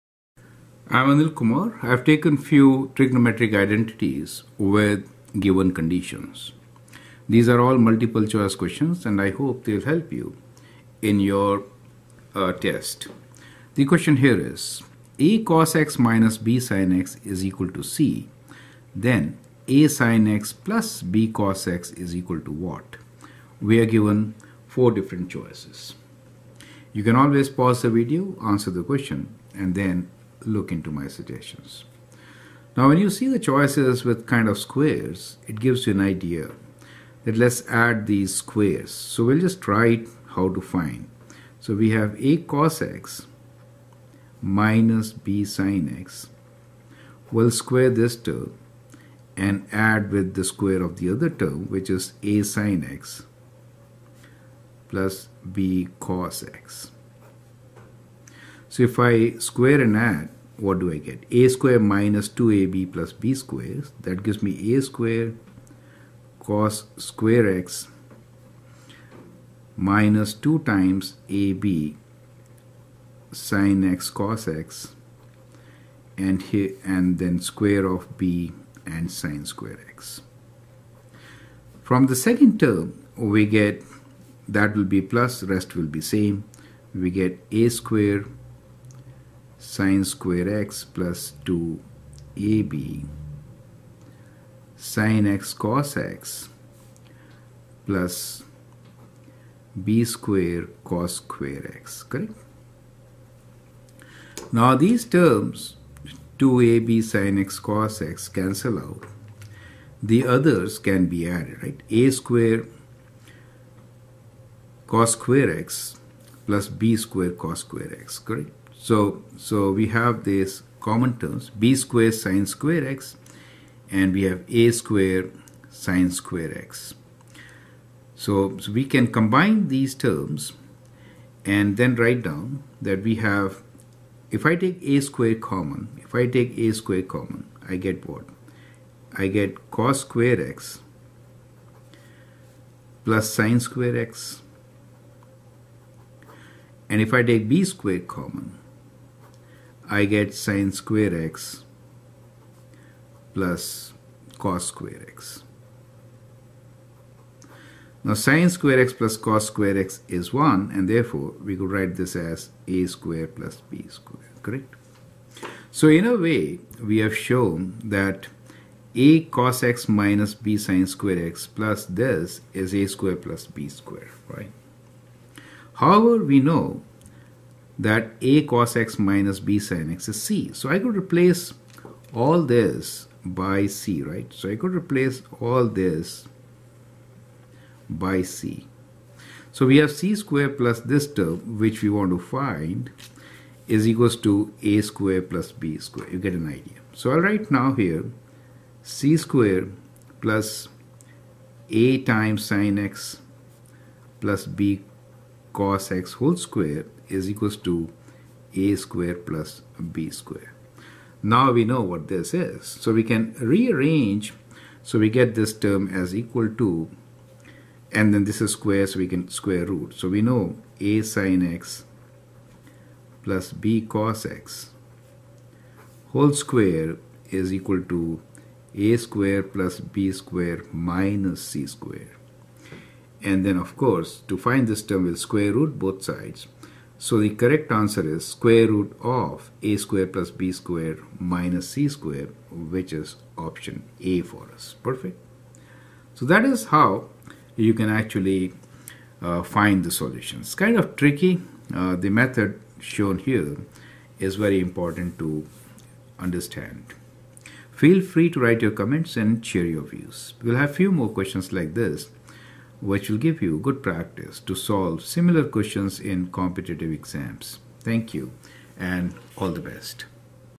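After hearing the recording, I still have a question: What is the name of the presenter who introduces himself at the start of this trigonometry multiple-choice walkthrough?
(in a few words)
Anil Kumar.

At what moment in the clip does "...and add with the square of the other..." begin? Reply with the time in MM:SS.
00:49.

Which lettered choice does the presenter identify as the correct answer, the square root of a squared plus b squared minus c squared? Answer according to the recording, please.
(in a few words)
Option A.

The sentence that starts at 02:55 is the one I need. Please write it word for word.
However, we know that a cos x minus b sin x is c.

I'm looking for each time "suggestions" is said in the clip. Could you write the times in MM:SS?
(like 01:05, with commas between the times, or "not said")
00:31.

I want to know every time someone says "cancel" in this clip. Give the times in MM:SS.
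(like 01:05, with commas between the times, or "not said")
01:48.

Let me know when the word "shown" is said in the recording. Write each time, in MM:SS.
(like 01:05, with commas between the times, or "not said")
02:47, 04:12.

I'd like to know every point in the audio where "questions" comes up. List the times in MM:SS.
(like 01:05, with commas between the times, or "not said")
00:08, 00:13, 00:28, 04:21, 04:25.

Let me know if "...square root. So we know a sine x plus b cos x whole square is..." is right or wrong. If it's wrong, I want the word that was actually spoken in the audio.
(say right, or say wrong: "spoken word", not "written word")
right.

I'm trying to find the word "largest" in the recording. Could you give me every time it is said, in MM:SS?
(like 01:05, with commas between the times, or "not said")
not said.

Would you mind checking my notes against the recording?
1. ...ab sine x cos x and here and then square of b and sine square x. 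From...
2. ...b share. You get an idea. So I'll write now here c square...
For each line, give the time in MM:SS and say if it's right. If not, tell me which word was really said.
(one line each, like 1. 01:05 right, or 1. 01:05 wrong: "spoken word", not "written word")
1. 01:11 right
2. 03:15 wrong: "square", not "share".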